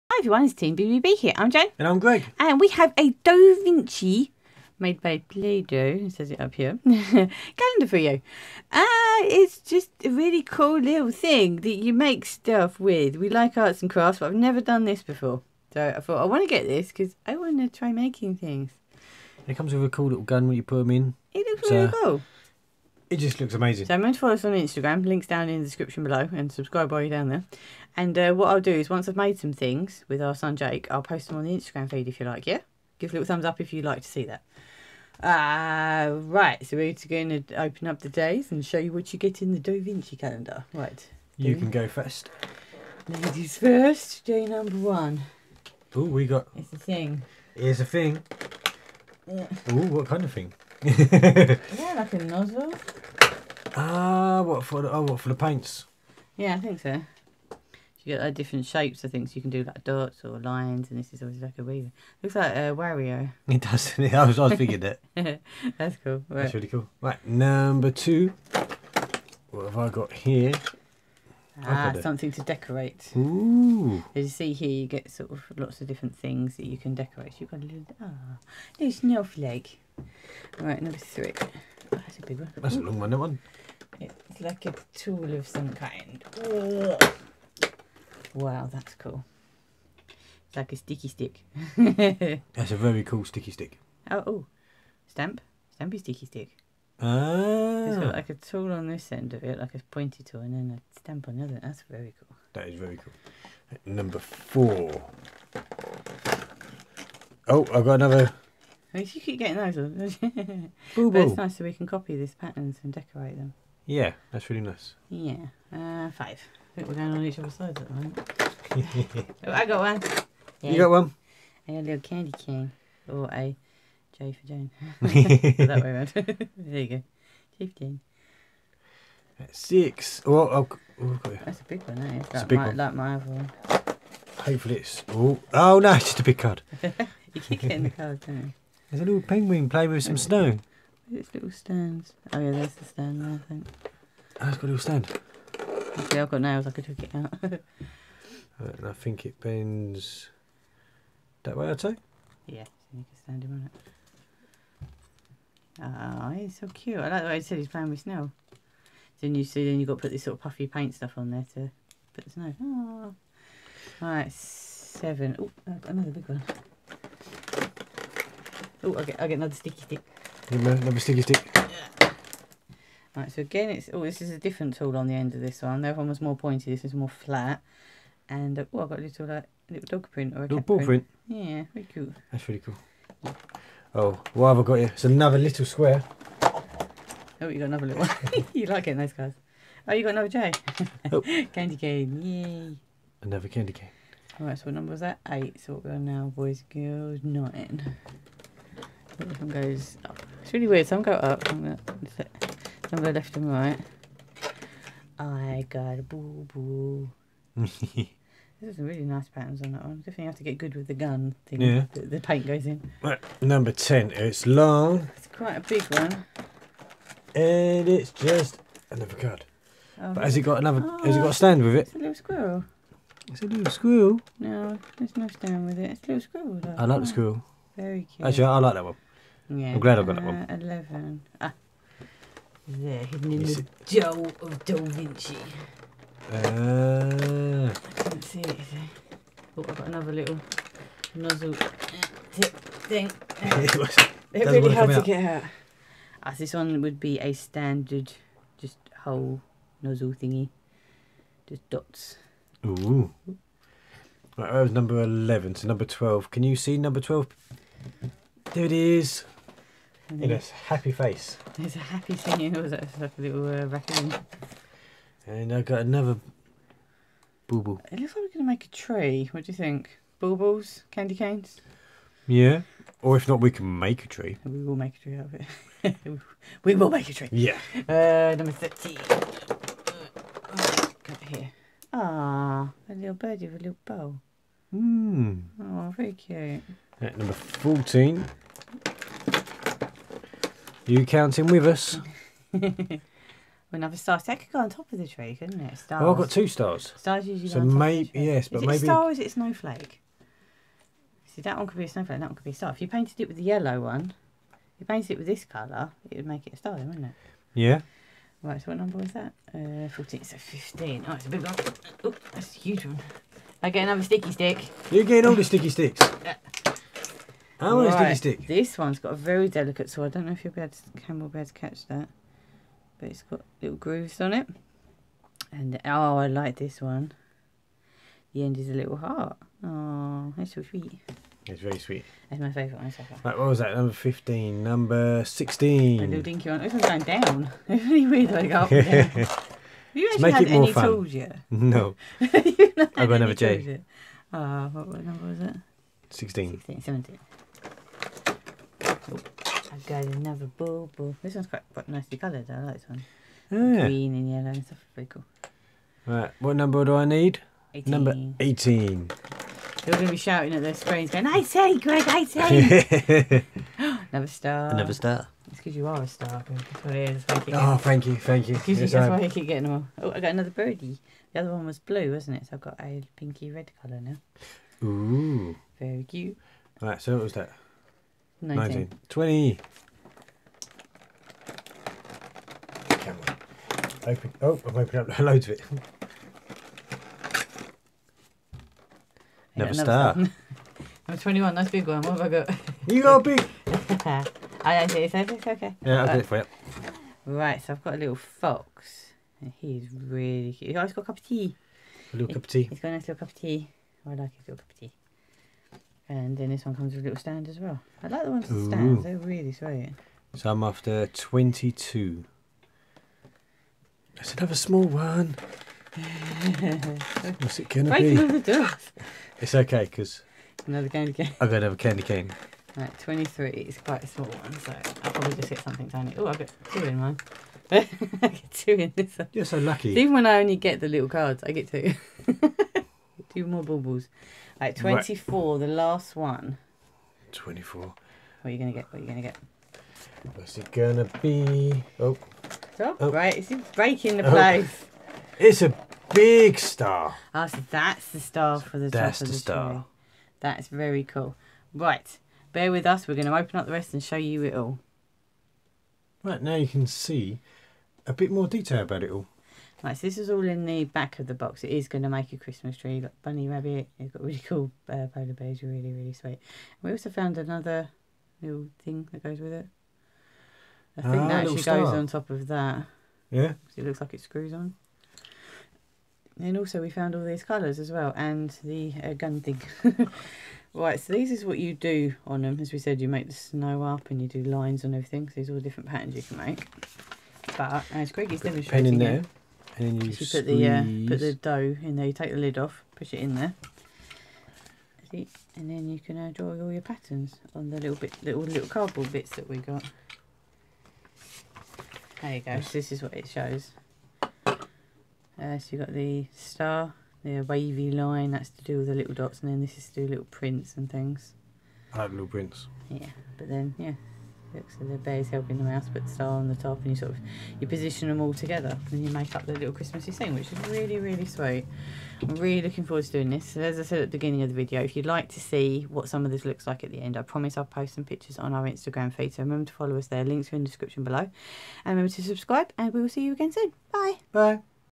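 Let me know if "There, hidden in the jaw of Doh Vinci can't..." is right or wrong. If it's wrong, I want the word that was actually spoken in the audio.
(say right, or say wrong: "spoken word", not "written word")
right.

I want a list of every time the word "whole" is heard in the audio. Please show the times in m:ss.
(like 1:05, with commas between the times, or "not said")
4:09.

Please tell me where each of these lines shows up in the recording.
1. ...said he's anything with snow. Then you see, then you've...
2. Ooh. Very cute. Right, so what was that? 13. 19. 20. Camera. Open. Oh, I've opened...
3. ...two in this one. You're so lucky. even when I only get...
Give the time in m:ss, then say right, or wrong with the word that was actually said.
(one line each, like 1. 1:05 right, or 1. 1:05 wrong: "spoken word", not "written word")
1. 2:37 wrong: "playing", not "anything"
2. 6:14 wrong: "19", not "13"
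3. 7:08 right.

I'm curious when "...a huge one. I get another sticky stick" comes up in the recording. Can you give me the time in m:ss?
5:12.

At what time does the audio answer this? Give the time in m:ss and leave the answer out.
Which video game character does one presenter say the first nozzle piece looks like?
1:02.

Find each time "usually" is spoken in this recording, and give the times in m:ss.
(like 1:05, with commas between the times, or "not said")
4:57.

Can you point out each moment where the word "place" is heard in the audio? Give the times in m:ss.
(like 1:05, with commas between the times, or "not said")
7:24.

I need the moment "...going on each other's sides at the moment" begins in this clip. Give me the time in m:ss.
1:56.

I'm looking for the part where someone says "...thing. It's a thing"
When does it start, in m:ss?
0:46.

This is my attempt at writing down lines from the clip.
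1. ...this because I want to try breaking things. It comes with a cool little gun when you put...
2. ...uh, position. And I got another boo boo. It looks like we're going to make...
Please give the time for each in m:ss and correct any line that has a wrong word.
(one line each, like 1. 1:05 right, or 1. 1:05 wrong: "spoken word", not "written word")
1. 0:16 wrong: "making", not "breaking"
2. 4:23 wrong: "raccoon", not "position".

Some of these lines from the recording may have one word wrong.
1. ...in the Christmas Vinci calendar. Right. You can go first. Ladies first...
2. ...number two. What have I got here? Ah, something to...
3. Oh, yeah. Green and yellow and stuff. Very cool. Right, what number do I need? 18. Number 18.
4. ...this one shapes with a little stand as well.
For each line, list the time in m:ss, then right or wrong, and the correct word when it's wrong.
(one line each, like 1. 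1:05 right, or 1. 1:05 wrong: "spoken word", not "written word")
1. 0:39 wrong: "Doh", not "Christmas"
2. 1:07 right
3. 5:53 right
4. 6:46 wrong: "comes", not "shapes".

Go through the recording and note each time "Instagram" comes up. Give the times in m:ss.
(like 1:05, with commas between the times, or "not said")
0:24, 0:31, 8:48.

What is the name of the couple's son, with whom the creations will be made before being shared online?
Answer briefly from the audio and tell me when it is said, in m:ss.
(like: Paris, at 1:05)
Jake, at 0:30.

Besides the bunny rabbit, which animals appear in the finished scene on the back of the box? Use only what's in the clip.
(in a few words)
Polar bears.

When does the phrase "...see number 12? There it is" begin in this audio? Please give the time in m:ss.
4:16.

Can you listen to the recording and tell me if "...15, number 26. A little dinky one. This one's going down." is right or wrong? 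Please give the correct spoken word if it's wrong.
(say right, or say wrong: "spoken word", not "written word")
wrong: "16", not "26".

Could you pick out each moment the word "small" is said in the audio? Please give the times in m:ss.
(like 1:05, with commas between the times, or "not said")
6:54, 7:04.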